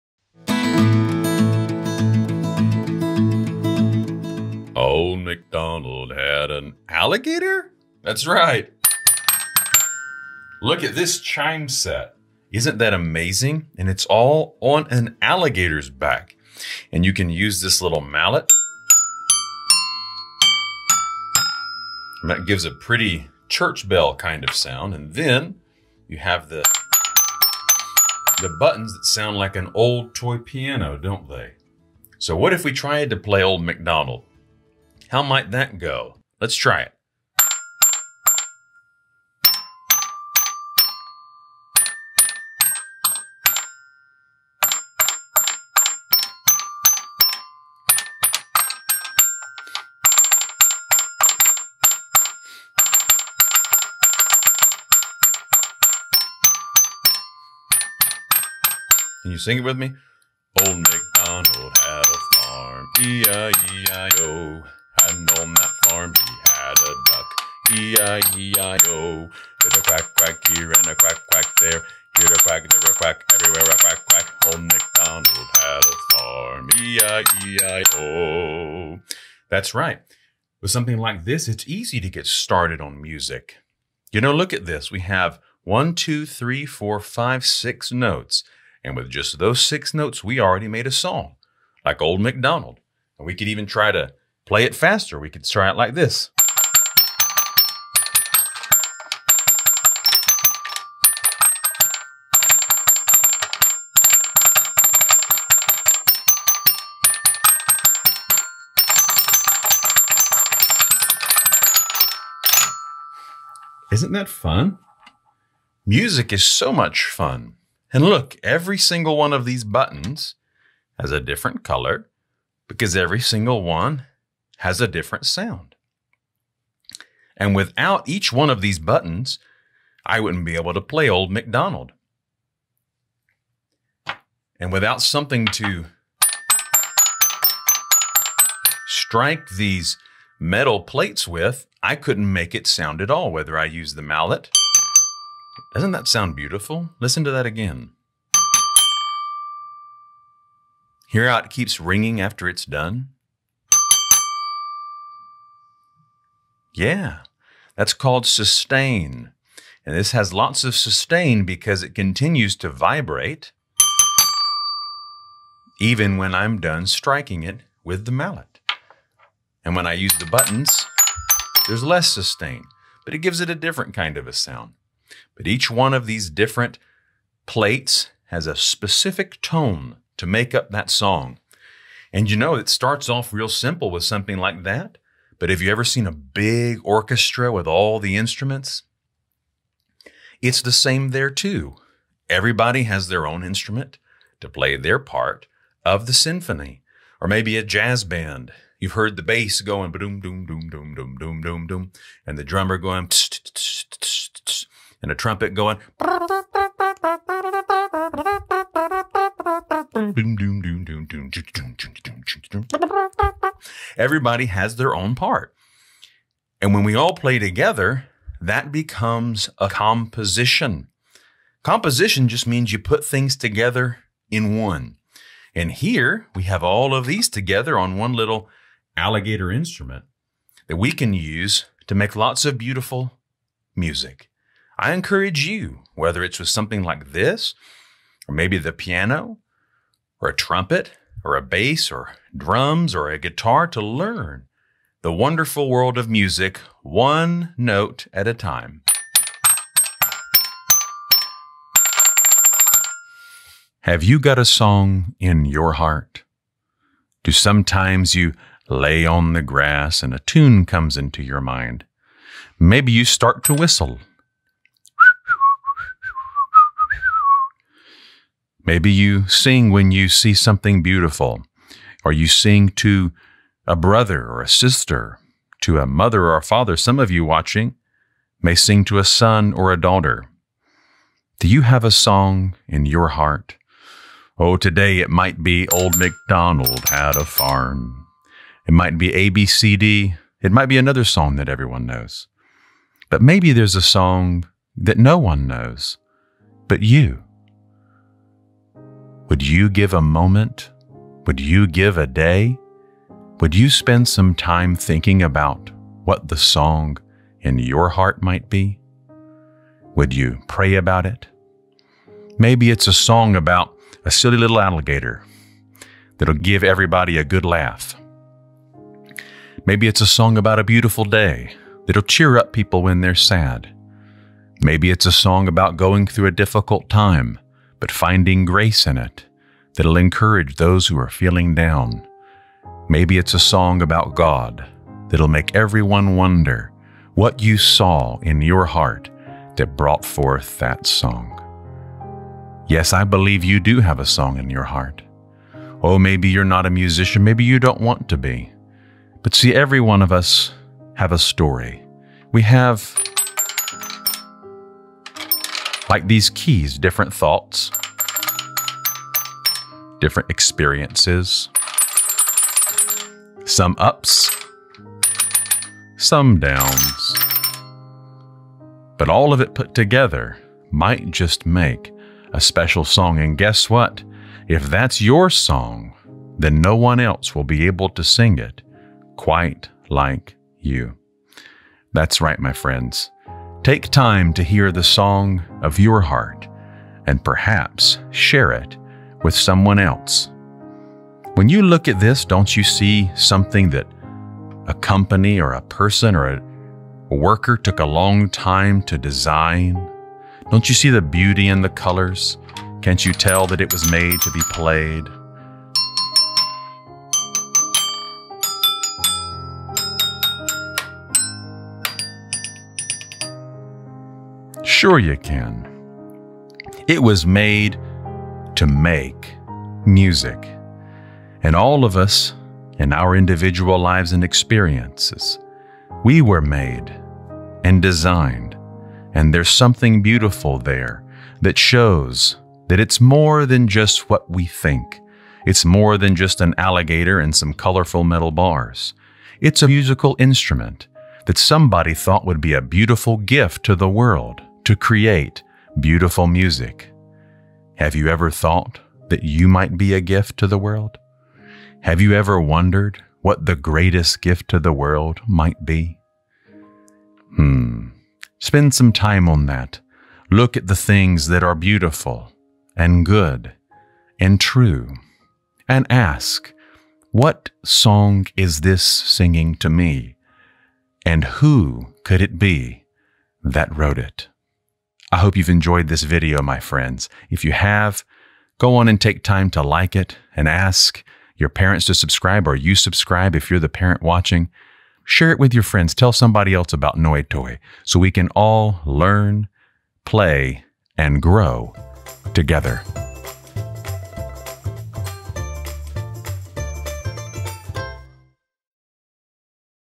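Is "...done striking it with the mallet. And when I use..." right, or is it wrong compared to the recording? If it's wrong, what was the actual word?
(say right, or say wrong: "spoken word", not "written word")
right.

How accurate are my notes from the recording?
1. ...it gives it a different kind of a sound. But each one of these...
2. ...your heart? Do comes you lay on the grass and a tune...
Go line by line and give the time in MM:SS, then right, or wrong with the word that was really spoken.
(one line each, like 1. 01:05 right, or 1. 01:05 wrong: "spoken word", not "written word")
1. 02:53 right
2. 04:15 wrong: "sometimes", not "comes".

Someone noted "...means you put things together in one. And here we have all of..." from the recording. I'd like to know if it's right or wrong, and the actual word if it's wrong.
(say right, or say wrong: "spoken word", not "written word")
right.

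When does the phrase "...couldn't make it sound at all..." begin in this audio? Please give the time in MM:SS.
02:21.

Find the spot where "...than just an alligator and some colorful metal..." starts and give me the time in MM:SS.
07:15.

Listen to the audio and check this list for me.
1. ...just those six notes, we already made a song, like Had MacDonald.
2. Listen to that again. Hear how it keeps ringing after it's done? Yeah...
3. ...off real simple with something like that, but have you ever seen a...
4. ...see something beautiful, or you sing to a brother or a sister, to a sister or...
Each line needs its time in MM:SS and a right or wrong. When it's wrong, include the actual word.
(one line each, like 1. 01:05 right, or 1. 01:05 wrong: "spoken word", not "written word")
1. 01:29 wrong: "Old", not "Had"
2. 02:26 right
3. 03:03 right
4. 04:30 wrong: "mother", not "sister".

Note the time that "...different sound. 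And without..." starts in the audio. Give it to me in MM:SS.
02:04.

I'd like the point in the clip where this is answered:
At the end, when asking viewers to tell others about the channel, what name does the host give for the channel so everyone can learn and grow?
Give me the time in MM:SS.
08:06.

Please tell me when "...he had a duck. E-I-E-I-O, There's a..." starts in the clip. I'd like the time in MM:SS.
01:06.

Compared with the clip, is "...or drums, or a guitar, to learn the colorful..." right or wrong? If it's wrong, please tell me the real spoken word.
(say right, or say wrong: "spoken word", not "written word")
wrong: "wonderful", not "colorful".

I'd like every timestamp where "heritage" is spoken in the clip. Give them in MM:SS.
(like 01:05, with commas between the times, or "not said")
not said.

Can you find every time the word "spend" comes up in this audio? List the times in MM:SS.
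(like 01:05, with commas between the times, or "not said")
05:03, 07:38.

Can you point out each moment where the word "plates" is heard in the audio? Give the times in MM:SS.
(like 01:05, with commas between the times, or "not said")
02:20, 02:57.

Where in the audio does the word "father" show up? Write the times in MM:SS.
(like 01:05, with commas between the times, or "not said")
04:36.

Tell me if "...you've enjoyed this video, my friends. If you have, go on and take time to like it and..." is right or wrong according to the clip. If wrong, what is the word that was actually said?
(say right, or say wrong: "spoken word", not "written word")
right.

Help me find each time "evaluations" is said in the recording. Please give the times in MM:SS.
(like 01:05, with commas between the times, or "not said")
not said.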